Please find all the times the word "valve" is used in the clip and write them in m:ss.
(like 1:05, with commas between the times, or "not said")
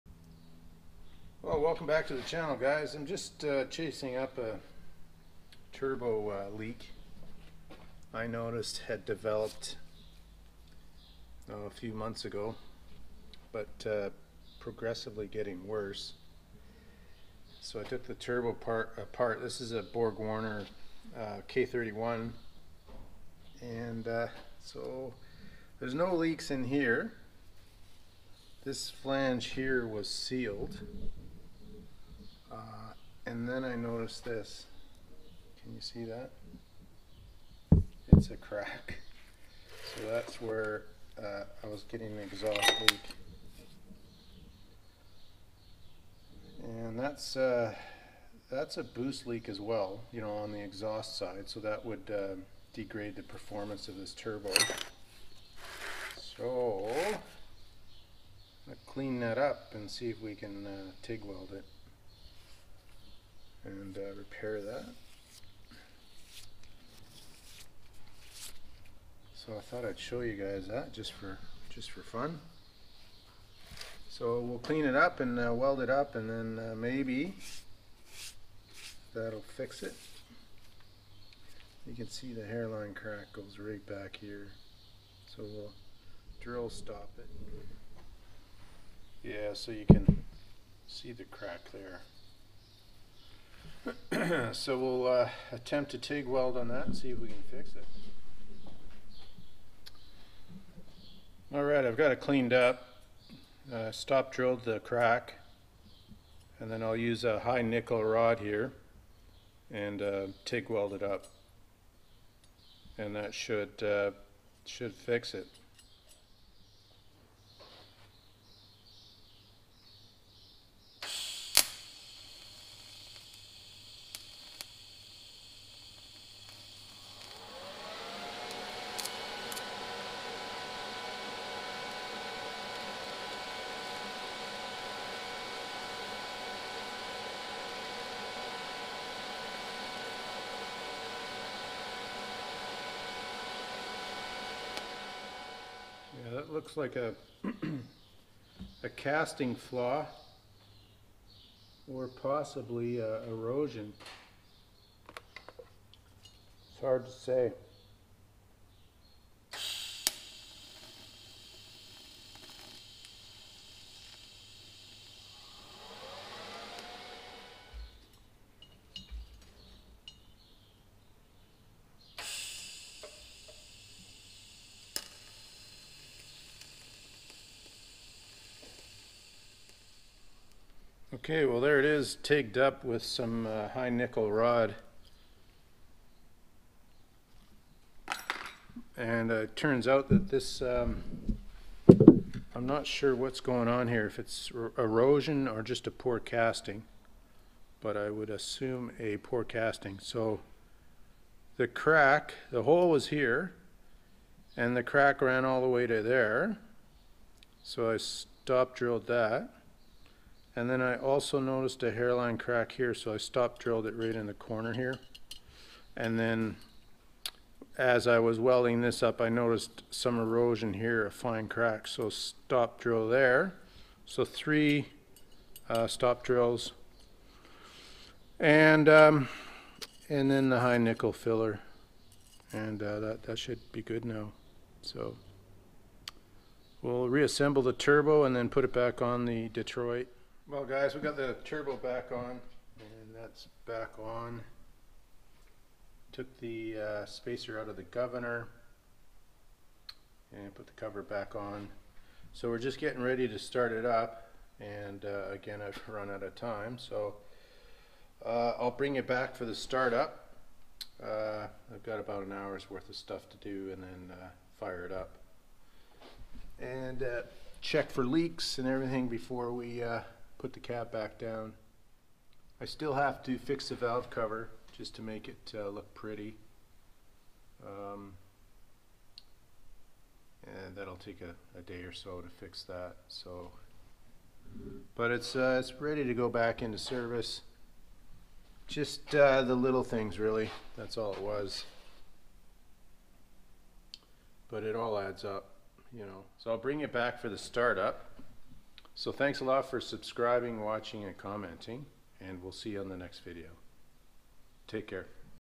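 4:33.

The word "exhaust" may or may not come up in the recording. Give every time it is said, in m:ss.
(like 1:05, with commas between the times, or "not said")
0:42, 0:50.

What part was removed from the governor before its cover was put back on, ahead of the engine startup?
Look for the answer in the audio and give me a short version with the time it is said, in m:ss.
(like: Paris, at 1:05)
Spacer, at 4:07.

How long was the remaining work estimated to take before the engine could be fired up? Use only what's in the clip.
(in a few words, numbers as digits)
About an hour.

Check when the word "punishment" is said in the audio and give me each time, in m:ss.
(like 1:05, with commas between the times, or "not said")
not said.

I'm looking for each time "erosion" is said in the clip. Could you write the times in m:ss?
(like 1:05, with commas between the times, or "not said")
2:33, 3:14, 3:40.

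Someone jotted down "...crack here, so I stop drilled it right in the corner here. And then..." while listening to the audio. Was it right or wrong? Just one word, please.
right.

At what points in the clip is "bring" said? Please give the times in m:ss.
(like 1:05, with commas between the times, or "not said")
4:18, 4:56.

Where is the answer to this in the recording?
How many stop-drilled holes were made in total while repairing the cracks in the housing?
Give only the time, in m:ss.
3:44.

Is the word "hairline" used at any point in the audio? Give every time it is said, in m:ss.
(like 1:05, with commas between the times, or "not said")
1:22, 3:31.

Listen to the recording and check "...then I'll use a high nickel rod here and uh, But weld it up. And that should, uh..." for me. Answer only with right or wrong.
wrong.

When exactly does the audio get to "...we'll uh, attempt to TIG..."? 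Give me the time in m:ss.
1:34.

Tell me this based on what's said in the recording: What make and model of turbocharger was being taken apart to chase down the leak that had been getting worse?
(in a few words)
BorgWarner K31.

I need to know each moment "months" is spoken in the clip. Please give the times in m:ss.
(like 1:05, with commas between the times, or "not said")
0:11.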